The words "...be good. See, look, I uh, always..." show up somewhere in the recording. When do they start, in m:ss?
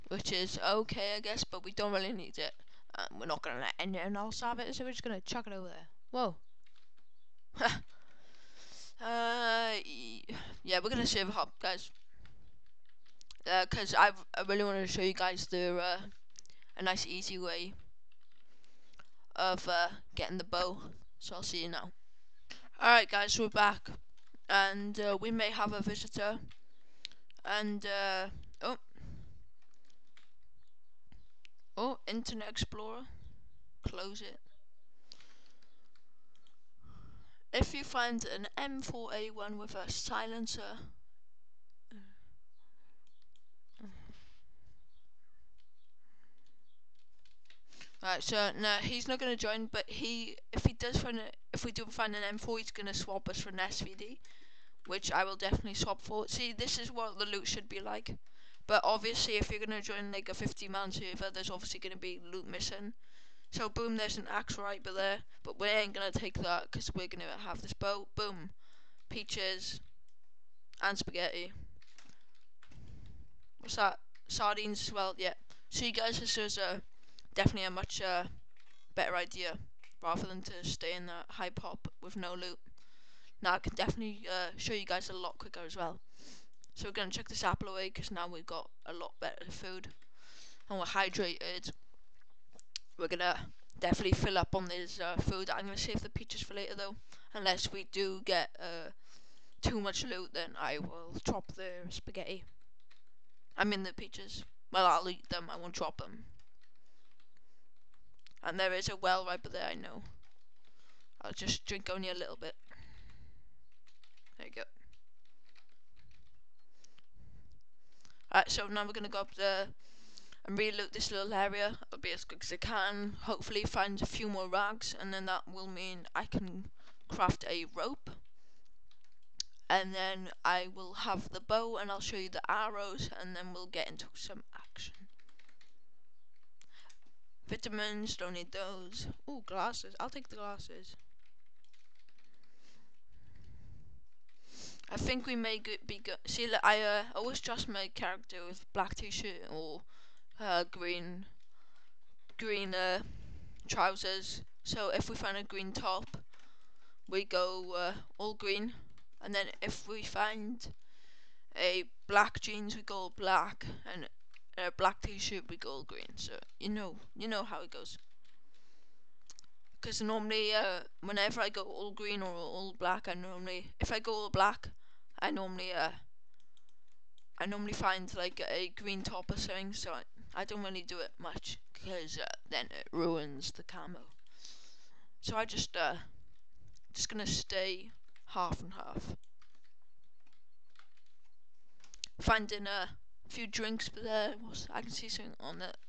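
2:25.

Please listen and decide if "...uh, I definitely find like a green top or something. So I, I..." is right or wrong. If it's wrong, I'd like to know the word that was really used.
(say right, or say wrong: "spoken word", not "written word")
wrong: "normally", not "definitely".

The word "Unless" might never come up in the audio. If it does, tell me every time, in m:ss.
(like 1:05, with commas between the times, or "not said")
1:37.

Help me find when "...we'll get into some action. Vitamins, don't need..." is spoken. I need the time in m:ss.
2:13.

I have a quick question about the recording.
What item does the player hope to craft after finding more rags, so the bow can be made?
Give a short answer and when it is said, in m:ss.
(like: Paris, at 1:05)
A rope, at 2:07.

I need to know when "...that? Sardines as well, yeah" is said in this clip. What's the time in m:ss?
1:13.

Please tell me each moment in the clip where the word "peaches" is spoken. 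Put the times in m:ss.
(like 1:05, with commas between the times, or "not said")
1:09, 1:36, 1:43.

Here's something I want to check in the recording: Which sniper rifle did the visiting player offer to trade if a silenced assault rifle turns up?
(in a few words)
SVD.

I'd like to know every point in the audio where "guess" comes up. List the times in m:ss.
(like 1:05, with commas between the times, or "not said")
0:01.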